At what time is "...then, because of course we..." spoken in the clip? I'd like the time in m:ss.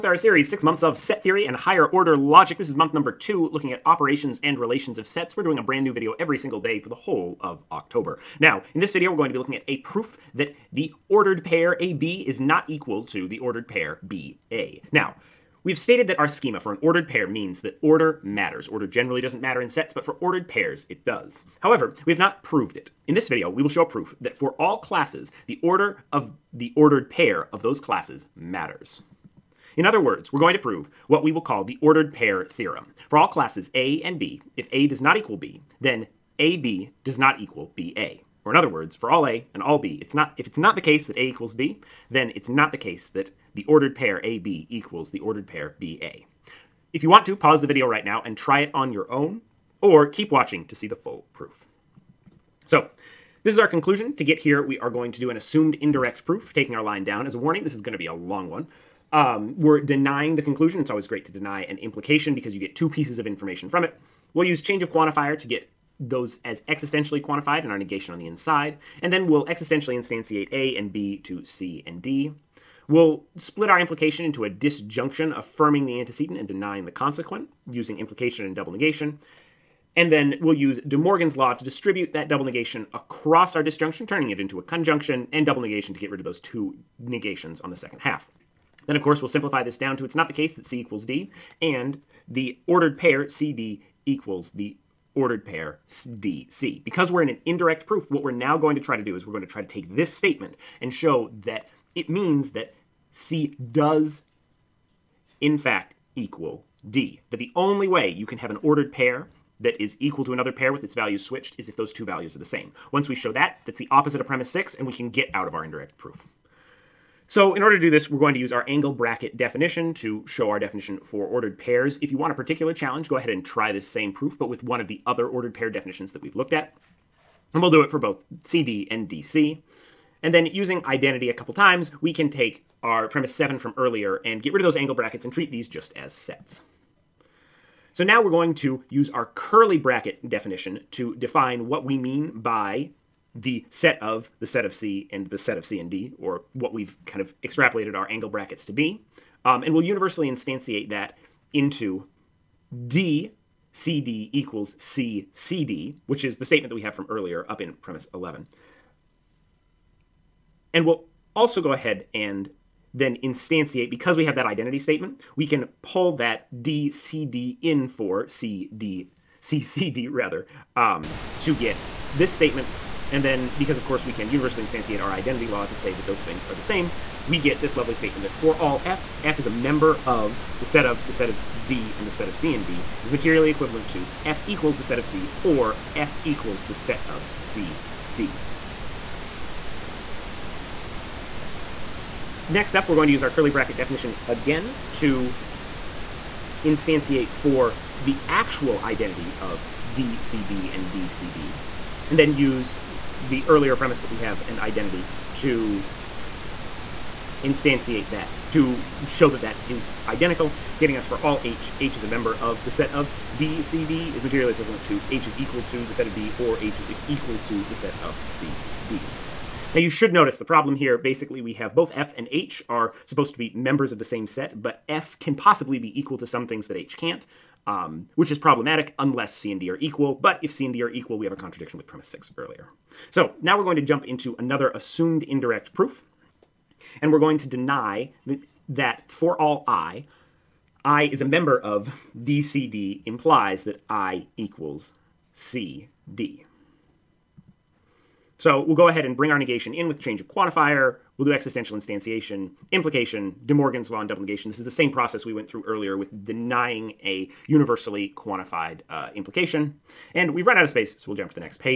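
2:53.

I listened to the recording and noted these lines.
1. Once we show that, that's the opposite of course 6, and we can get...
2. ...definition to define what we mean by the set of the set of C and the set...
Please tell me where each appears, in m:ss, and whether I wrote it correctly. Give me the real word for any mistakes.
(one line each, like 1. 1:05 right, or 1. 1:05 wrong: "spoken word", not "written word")
1. 1:52 wrong: "premise", not "course"
2. 2:20 right.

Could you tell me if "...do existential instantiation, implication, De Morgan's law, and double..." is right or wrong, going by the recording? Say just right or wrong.
right.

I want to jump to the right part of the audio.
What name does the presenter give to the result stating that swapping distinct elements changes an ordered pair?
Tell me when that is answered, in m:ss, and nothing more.
0:31.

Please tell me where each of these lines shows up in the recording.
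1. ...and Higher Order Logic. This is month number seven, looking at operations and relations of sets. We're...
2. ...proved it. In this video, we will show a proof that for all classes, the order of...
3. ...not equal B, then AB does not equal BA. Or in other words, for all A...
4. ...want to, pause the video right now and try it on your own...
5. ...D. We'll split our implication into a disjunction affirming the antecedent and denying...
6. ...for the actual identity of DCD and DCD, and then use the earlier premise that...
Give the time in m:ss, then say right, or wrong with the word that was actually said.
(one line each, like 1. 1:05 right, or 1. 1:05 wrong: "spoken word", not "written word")
1. 0:01 wrong: "two", not "seven"
2. 0:22 right
3. 0:34 right
4. 0:47 right
5. 1:12 right
6. 3:17 right.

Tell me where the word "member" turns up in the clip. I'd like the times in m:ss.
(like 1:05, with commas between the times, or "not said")
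2:59, 3:32, 3:43, 4:01.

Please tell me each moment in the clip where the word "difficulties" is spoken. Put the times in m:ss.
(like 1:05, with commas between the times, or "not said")
not said.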